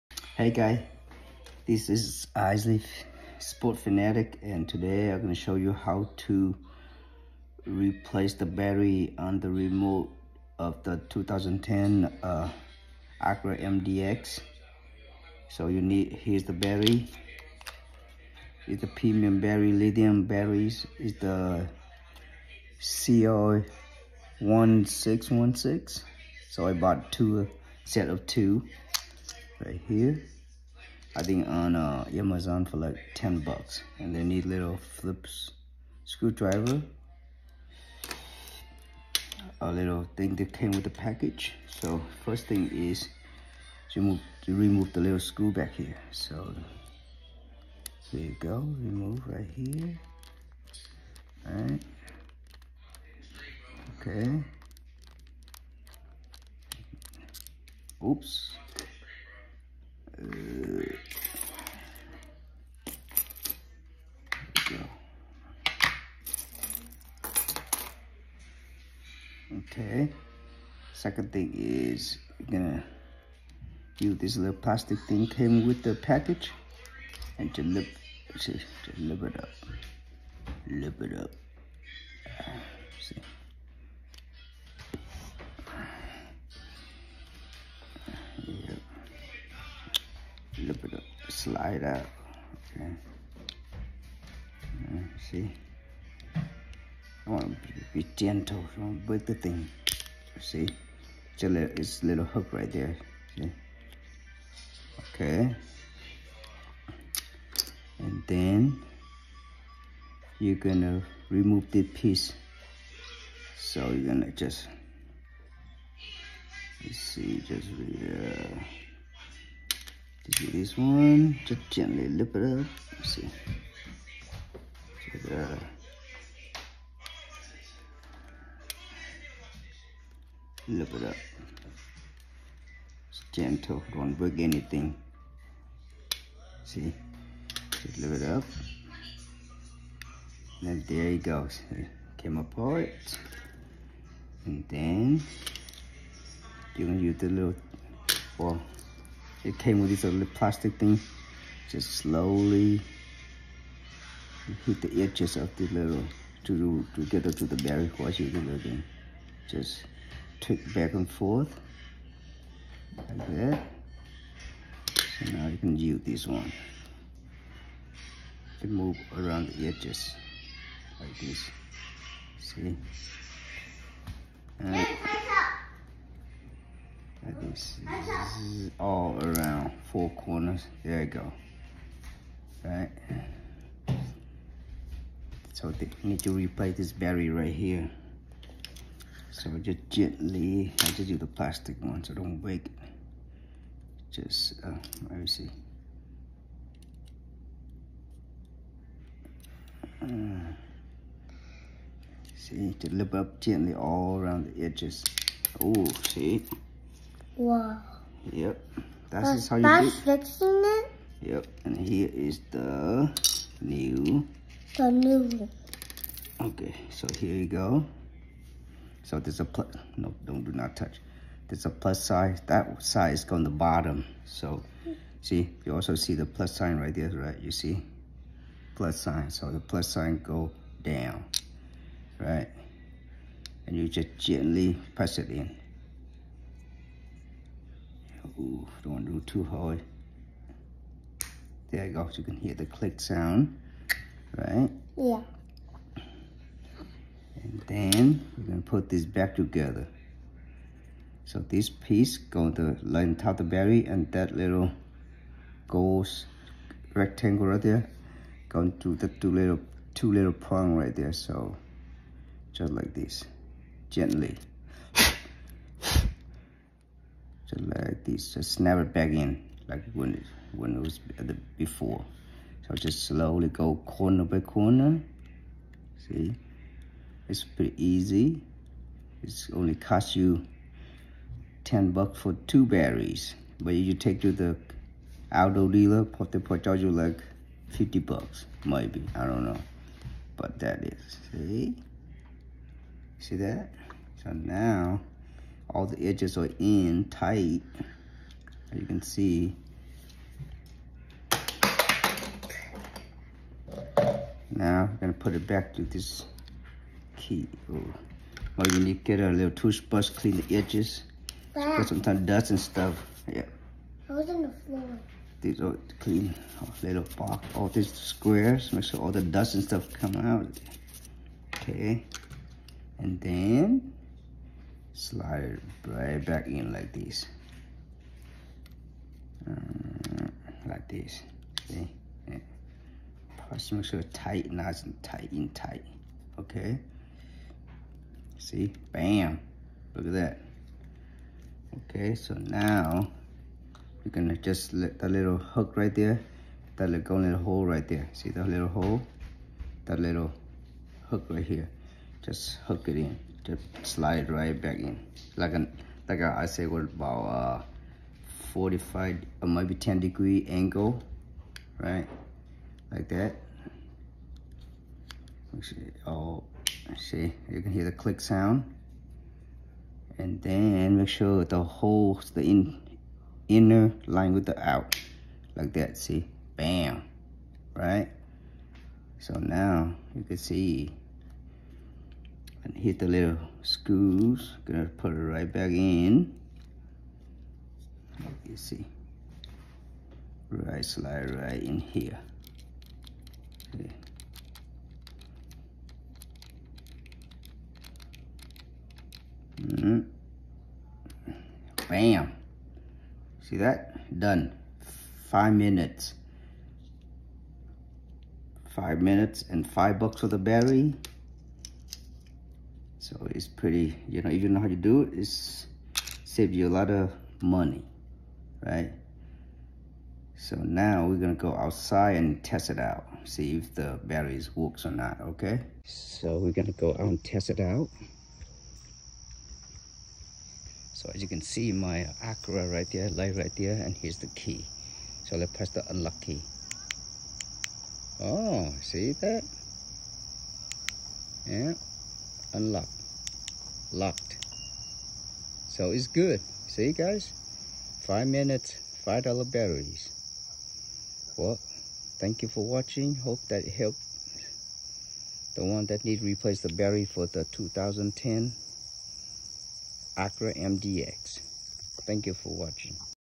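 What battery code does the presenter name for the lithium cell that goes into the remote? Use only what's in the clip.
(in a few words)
1616.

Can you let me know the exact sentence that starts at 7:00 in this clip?
So now we're gonna go outside and test it out.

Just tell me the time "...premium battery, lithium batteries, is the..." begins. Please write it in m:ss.
0:18.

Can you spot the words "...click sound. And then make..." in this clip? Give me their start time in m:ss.
6:07.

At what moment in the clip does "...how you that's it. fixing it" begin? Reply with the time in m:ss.
3:29.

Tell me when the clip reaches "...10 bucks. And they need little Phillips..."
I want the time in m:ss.
0:33.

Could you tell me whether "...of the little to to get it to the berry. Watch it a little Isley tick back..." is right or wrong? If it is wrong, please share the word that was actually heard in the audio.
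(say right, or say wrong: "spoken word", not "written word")
wrong: "Just", not "Isley".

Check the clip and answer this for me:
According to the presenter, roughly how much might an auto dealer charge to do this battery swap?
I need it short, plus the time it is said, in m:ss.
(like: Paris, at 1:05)
50 bucks, at 4:47.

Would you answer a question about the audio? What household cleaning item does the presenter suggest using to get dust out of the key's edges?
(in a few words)
toothbrush.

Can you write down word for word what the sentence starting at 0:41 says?
So first thing is to, remove, to remove the little screw back here.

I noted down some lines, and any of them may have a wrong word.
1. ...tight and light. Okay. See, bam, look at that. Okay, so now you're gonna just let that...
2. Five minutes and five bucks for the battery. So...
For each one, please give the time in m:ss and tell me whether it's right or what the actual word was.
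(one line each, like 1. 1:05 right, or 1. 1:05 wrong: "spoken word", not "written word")
1. 5:35 wrong: "tight", not "light"
2. 6:48 right.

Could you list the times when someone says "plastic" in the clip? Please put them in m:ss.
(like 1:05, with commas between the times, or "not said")
1:14, 2:30, 3:11.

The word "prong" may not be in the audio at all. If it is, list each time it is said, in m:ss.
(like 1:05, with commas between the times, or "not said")
4:20.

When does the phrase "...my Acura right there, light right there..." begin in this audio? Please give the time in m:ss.
7:11.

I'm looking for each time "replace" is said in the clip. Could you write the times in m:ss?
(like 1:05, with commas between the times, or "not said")
0:07, 3:06, 7:36.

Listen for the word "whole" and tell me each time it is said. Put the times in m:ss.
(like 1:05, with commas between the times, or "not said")
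6:11.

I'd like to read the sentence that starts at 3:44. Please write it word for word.
So see, you also see the plus sign right there, right?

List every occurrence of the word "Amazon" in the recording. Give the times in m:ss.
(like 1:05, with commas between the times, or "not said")
0:32.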